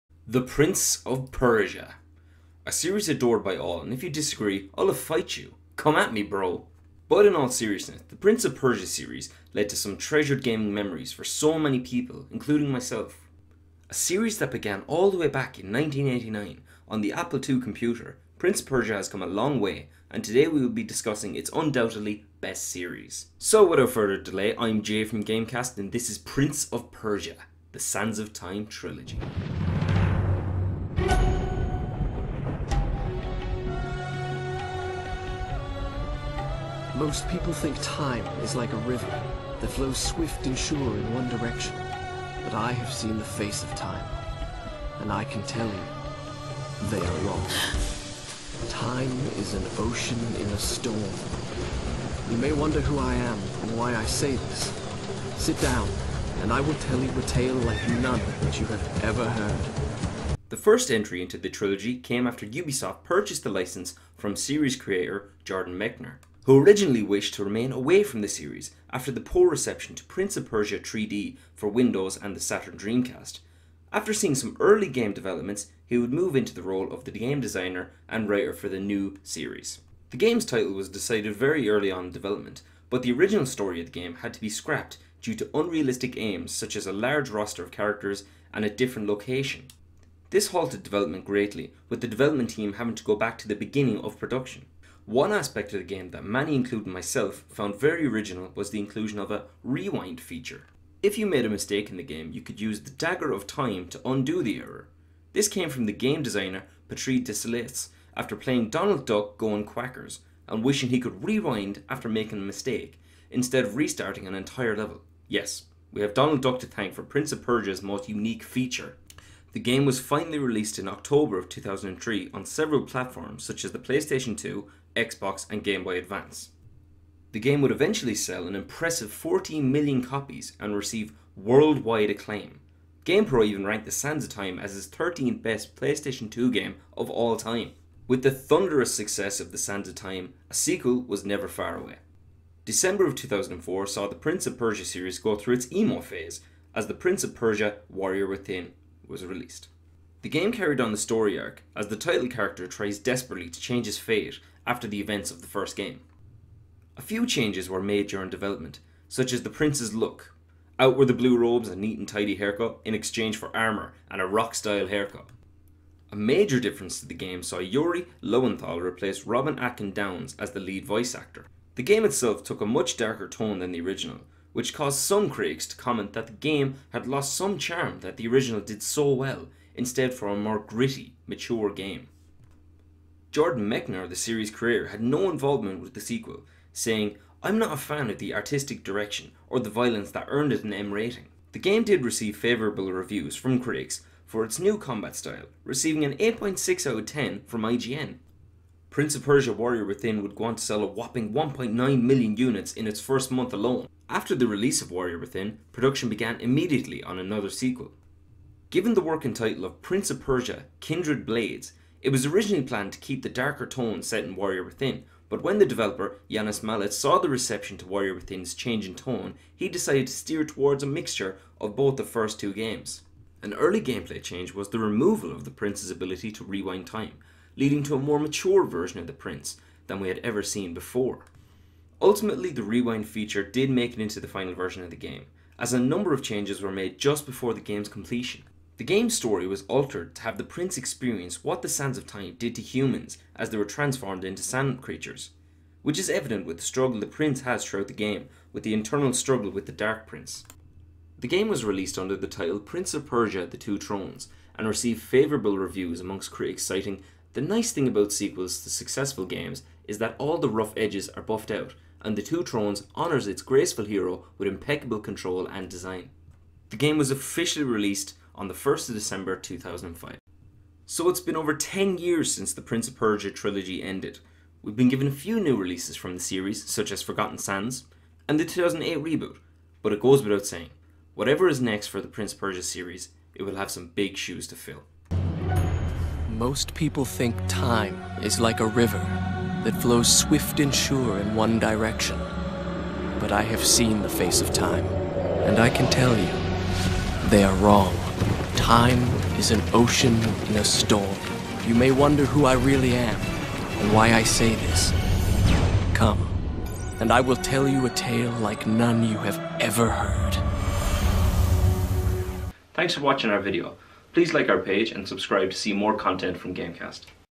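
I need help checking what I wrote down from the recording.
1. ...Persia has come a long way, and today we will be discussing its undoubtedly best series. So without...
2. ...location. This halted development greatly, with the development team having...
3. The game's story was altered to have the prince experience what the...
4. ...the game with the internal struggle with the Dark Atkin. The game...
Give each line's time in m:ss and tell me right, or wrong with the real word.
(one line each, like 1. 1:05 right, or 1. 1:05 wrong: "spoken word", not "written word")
1. 0:18 right
2. 1:29 right
3. 3:58 right
4. 4:07 wrong: "Prince", not "Atkin".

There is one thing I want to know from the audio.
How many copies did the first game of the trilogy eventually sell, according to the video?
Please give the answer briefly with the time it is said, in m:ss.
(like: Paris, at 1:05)
14 million, at 2:09.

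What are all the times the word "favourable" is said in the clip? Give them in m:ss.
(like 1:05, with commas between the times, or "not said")
3:12, 4:15.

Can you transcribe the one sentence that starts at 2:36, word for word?
A few changes were made during development, such as the prince's look.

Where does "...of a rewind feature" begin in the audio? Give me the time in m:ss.
1:39.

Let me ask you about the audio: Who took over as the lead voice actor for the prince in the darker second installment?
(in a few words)
Yuri Lowenthal.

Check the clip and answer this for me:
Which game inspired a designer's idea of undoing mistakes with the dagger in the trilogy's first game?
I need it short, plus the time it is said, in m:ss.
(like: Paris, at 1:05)
Donald Duck Going Quackers, at 1:48.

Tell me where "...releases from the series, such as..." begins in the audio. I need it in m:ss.
4:35.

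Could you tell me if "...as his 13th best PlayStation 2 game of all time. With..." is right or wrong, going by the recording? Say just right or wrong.
right.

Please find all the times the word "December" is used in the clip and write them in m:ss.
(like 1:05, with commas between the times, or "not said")
2:22, 4:28.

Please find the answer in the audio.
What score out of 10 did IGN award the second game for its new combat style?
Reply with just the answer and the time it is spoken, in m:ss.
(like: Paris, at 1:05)
8.6, at 3:16.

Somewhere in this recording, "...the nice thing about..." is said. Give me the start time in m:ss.
4:17.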